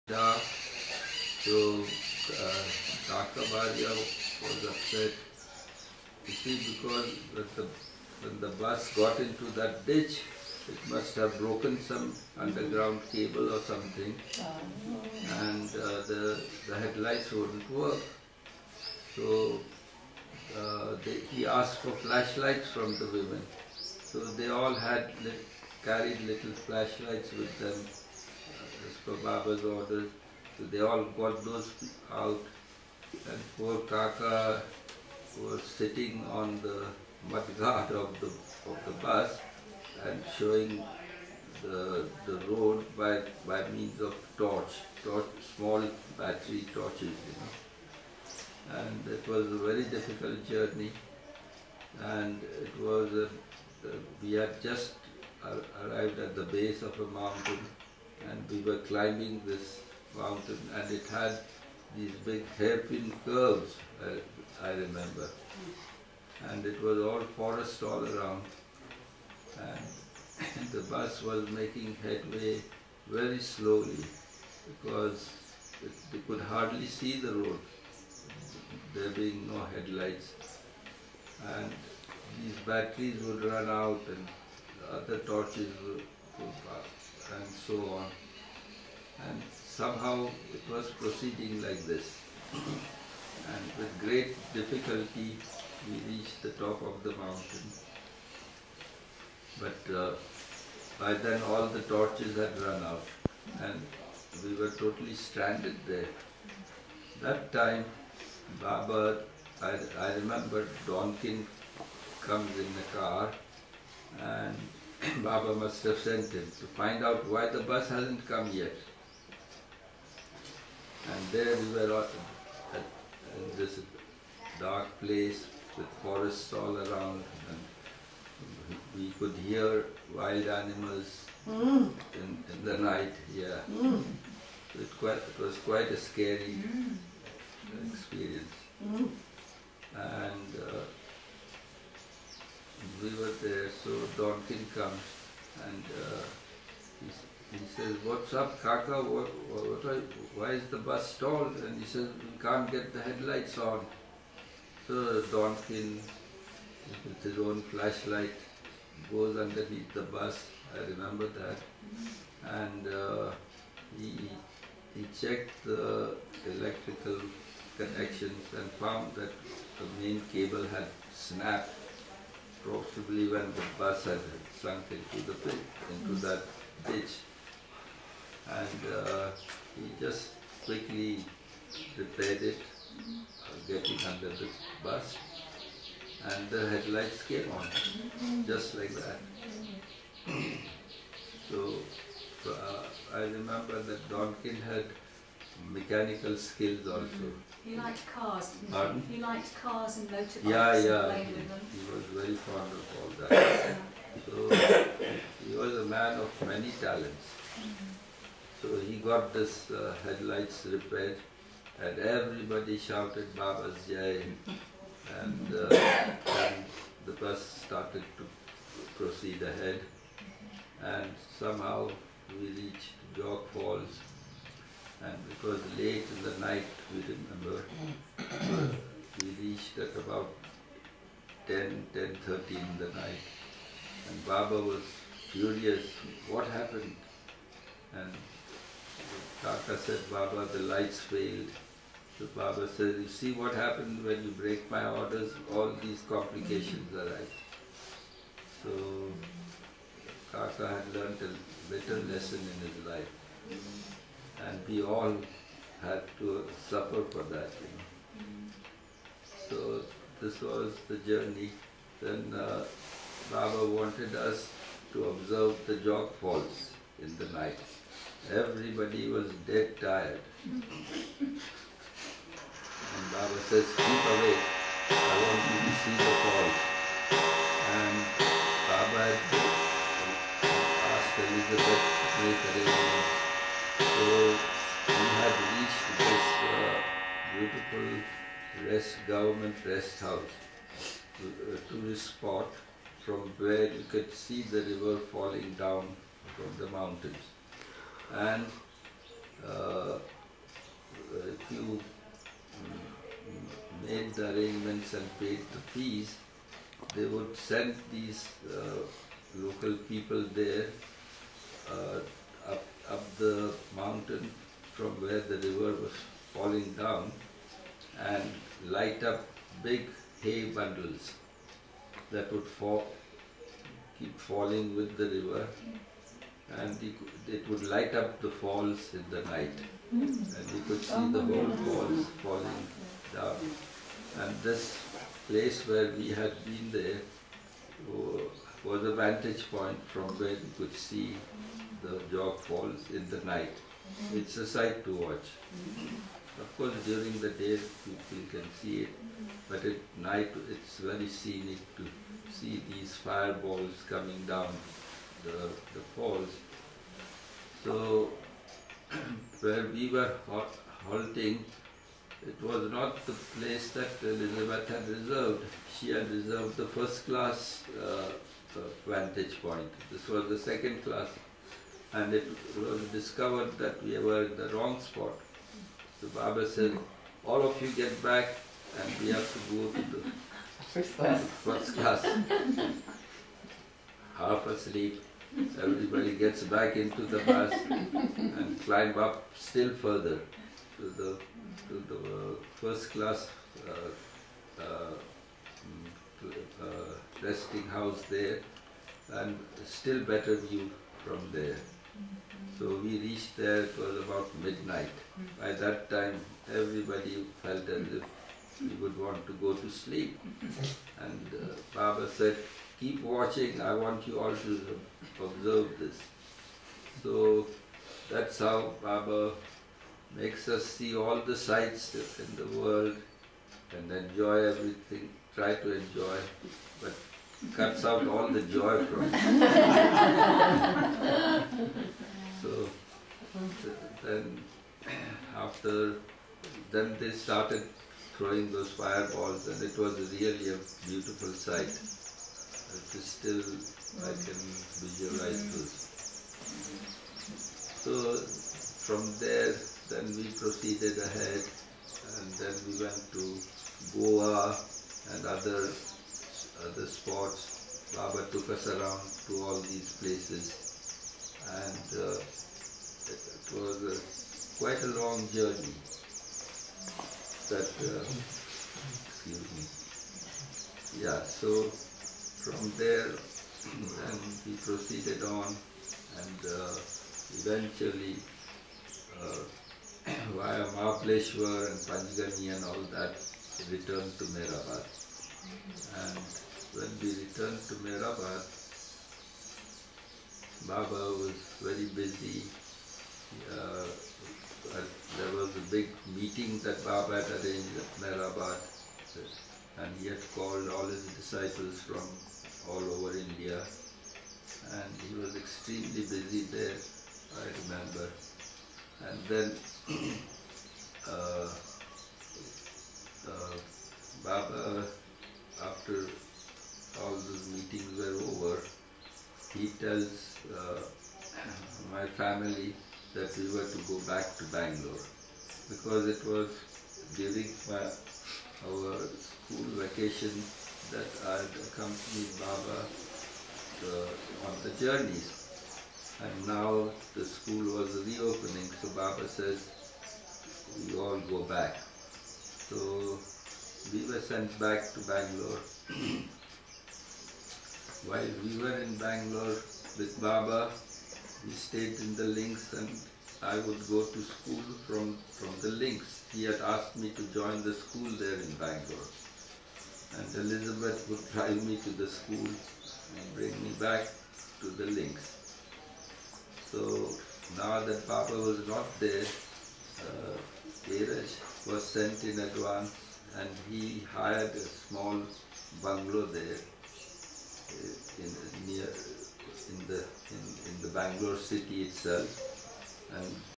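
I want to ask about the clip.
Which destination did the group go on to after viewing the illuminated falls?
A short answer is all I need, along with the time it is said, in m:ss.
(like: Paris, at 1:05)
Goa, at 7:33.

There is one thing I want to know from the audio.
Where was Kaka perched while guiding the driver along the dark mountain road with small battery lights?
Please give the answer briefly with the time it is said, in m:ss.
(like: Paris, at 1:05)
On the mudguard, at 0:37.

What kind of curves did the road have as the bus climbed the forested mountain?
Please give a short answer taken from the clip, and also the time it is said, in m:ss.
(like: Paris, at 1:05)
Hairpin curves, at 1:02.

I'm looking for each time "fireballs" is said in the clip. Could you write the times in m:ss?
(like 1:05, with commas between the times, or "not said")
5:52, 7:18.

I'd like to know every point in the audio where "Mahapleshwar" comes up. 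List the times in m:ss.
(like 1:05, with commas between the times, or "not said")
8:00.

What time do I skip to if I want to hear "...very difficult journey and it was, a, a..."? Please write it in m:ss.
0:49.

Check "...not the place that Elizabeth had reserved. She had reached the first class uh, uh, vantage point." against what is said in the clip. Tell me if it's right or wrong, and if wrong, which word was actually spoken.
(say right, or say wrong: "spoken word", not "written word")
wrong: "reserved", not "reached".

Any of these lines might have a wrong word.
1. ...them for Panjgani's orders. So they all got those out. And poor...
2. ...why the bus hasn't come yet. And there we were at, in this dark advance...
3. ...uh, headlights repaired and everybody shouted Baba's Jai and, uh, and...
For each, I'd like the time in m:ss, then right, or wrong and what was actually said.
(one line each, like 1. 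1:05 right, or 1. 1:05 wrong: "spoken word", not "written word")
1. 0:27 wrong: "Baba", not "Panjgani"
2. 1:57 wrong: "place", not "advance"
3. 3:29 right.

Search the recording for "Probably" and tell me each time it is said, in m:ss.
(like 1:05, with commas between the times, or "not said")
2:52.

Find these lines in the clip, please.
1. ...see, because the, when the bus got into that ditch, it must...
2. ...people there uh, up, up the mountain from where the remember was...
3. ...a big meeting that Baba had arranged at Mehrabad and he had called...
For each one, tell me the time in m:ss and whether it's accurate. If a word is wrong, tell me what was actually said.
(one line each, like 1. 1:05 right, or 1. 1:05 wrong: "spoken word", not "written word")
1. 0:06 right
2. 5:09 wrong: "river", not "remember"
3. 8:15 right.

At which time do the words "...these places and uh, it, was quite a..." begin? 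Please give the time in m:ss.
7:39.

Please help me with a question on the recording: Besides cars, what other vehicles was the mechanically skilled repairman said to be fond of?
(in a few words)
Motorbikes.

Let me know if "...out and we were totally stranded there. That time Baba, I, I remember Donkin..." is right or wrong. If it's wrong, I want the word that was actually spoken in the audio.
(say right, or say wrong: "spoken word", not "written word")
right.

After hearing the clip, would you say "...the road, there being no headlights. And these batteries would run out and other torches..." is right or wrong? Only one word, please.
right.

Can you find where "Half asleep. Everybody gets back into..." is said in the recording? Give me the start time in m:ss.
6:24.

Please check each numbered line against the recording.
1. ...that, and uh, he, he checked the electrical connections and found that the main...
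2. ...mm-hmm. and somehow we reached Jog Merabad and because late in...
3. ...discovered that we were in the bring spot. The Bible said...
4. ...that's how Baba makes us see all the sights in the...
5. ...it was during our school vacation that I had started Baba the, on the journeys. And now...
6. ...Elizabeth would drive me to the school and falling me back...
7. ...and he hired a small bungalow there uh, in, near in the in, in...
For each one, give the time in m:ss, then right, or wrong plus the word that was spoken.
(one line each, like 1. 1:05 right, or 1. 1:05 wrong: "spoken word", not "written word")
1. 2:41 right
2. 3:39 wrong: "Falls", not "Merabad"
3. 6:12 wrong: "wrong", not "bring"
4. 6:58 right
5. 8:46 wrong: "accompanied", not "started"
6. 9:20 wrong: "bring", not "falling"
7. 9:33 right.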